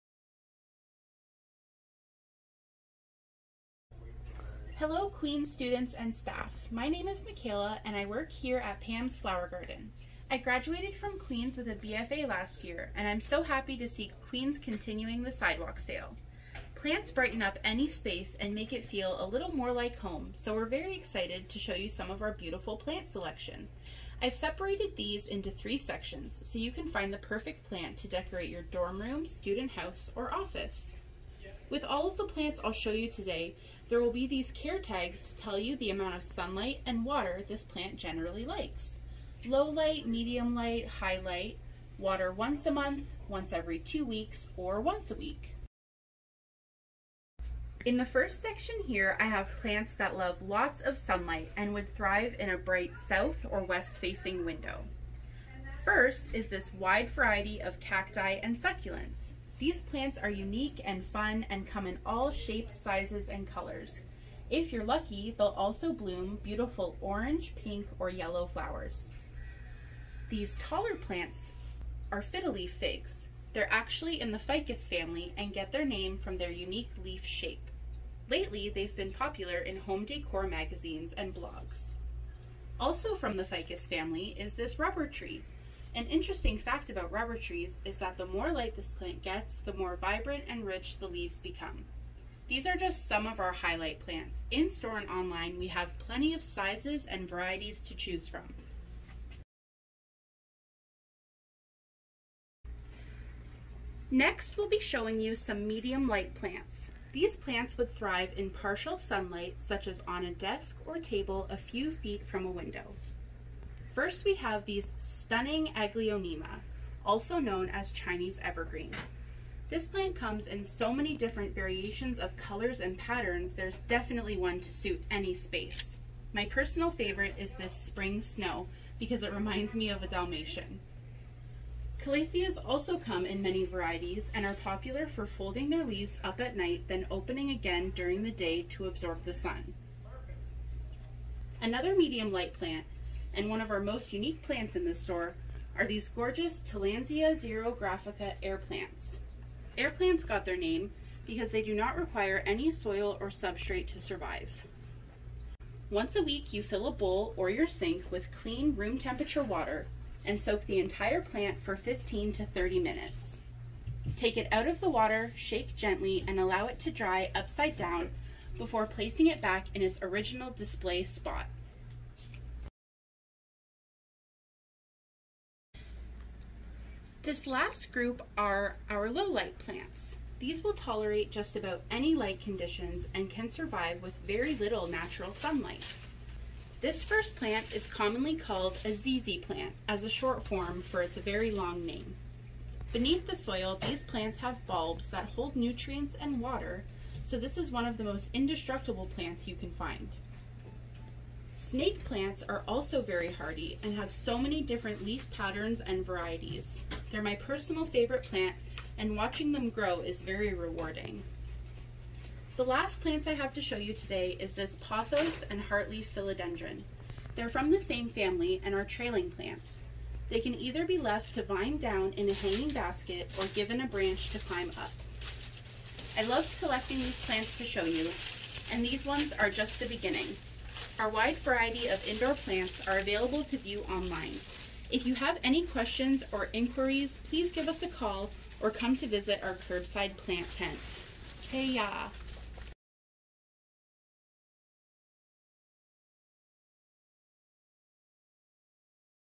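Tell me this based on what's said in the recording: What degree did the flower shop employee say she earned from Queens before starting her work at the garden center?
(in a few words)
BFA.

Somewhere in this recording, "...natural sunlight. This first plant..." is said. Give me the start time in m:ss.
3:04.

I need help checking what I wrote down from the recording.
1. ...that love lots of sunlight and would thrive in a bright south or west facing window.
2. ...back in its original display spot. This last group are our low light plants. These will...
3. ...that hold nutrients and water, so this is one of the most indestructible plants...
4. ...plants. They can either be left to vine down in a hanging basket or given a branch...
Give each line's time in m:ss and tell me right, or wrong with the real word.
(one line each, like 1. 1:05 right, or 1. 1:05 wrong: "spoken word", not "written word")
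1. 0:49 right
2. 2:49 right
3. 3:15 right
4. 3:39 right.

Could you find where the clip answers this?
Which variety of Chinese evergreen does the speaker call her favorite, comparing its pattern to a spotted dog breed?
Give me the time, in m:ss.
2:07.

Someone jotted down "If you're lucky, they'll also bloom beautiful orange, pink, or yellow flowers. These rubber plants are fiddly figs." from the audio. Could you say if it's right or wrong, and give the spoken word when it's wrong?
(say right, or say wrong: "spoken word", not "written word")
wrong: "taller", not "rubber".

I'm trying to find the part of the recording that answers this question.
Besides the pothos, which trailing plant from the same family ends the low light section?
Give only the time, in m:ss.
3:35.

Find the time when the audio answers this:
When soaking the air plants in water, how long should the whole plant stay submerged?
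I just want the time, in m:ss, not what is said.
2:41.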